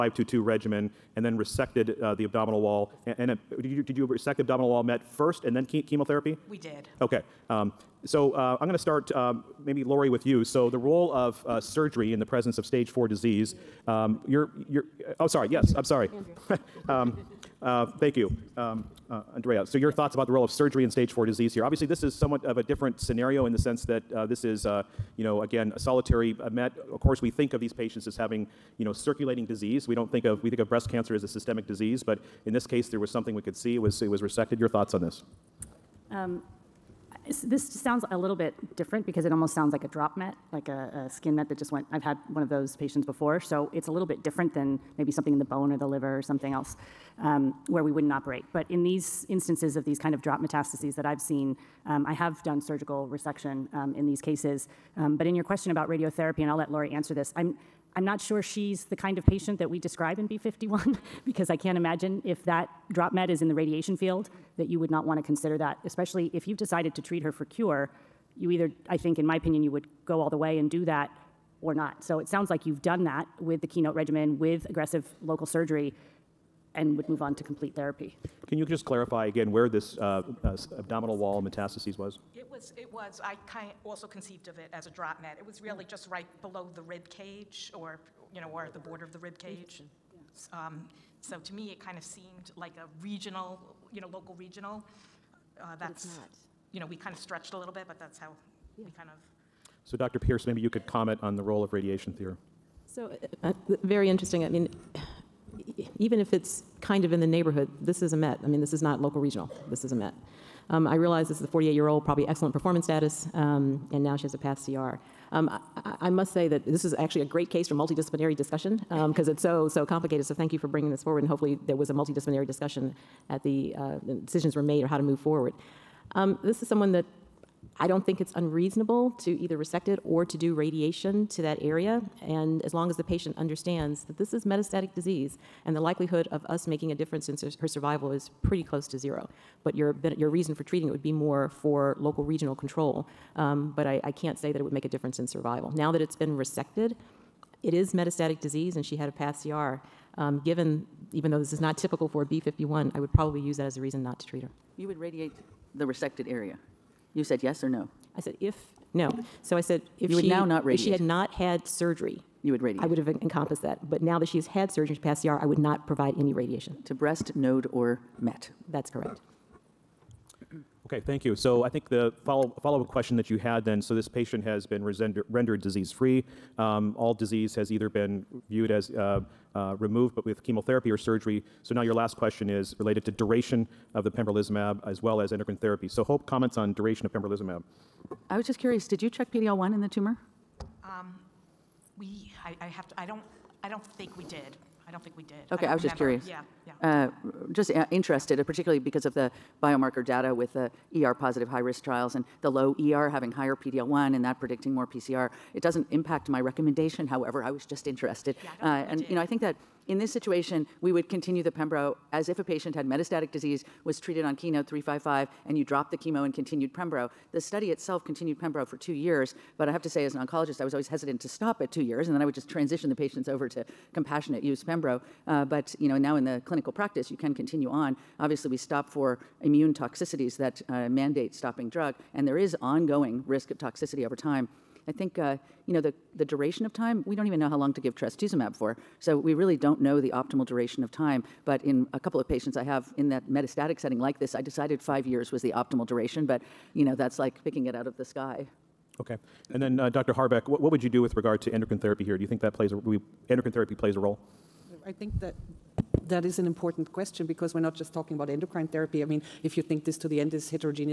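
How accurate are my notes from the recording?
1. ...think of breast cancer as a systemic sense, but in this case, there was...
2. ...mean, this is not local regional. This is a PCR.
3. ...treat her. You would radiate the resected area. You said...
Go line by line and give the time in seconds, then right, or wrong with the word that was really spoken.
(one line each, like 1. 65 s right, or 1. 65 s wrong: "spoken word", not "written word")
1. 30 s wrong: "disease", not "sense"
2. 108 s wrong: "Met", not "PCR"
3. 154 s right.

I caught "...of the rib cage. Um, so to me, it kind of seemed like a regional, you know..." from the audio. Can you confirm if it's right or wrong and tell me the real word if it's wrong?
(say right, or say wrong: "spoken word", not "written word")
right.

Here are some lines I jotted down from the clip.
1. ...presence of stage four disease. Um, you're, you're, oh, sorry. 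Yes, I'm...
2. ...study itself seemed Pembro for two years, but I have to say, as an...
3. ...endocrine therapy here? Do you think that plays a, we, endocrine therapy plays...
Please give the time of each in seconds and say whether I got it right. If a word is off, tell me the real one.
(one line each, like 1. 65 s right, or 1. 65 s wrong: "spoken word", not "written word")
1. 12 s right
2. 217 s wrong: "continued", not "seemed"
3. 251 s right.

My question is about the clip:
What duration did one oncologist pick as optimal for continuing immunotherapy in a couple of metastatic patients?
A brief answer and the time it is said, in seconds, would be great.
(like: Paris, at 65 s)
5 years, at 244 s.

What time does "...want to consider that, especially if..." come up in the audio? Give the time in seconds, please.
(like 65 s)
65 s.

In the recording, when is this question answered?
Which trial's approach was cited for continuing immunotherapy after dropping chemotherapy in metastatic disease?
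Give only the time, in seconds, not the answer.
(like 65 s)
214 s.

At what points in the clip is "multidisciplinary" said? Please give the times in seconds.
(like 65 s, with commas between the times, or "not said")
117 s, 121 s.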